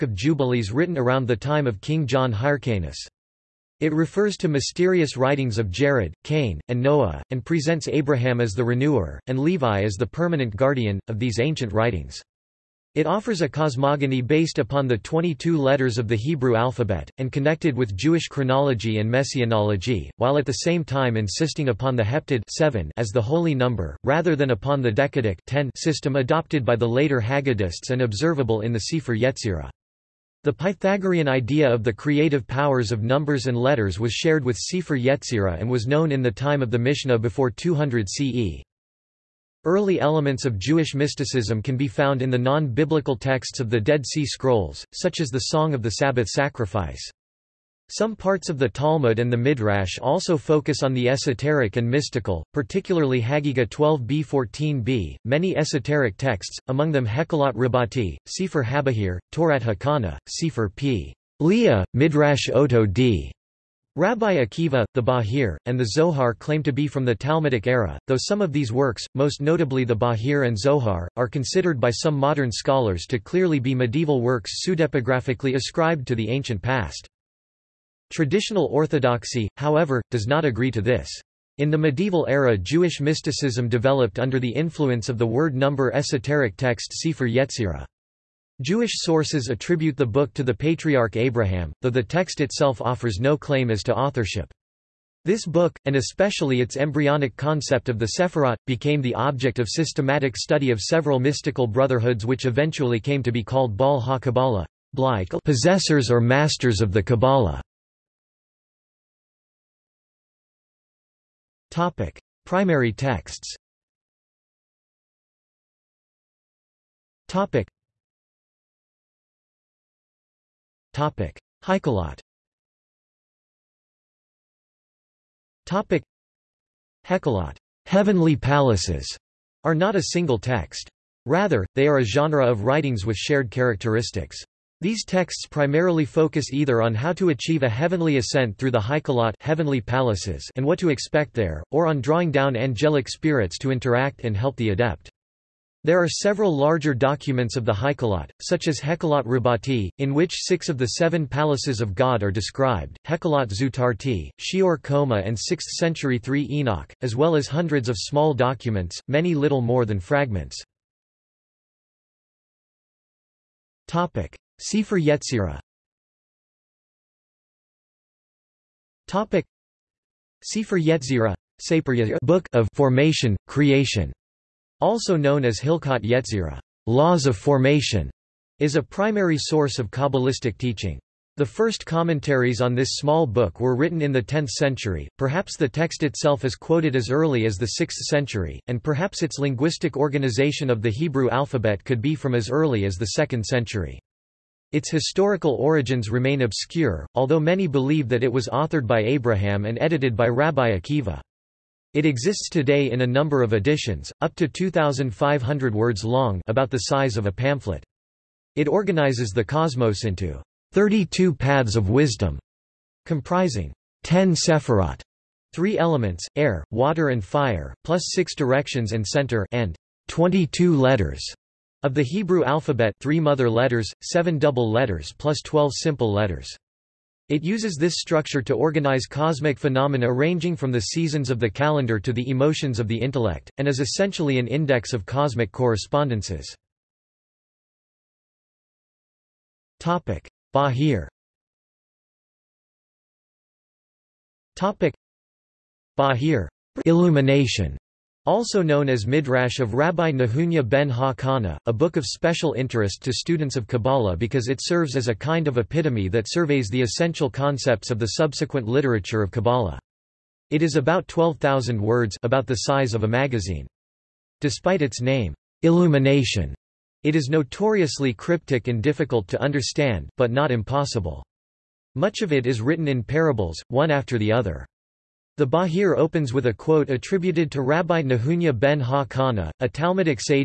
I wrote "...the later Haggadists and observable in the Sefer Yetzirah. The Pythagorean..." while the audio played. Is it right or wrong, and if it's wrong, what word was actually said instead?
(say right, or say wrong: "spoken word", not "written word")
right.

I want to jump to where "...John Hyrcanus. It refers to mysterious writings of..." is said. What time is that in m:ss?
0:02.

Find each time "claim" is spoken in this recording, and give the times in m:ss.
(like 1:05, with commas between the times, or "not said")
1:06, 1:33.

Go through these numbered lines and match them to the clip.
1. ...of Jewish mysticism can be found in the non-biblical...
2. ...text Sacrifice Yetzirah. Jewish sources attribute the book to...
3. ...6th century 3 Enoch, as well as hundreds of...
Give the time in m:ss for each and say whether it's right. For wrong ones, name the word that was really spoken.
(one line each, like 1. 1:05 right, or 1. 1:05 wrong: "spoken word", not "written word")
1. 0:40 right
2. 1:26 wrong: "Sefer", not "Sacrifice"
3. 2:35 right.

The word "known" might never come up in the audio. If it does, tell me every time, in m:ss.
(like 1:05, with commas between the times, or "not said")
0:35, 2:55, 4:08.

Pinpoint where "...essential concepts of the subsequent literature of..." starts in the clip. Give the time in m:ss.
4:16.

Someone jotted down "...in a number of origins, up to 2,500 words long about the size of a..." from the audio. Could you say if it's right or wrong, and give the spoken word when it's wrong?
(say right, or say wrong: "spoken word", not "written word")
wrong: "editions", not "origins".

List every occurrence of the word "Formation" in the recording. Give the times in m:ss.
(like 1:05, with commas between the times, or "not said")
2:52, 2:57.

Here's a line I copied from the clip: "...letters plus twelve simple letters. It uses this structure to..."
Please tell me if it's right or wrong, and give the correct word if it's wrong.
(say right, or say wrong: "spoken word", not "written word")
right.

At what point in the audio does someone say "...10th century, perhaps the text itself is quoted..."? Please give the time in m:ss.
3:04.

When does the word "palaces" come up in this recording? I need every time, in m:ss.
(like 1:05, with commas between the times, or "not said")
2:08, 2:19, 2:31.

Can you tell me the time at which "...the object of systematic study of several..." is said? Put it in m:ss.
1:39.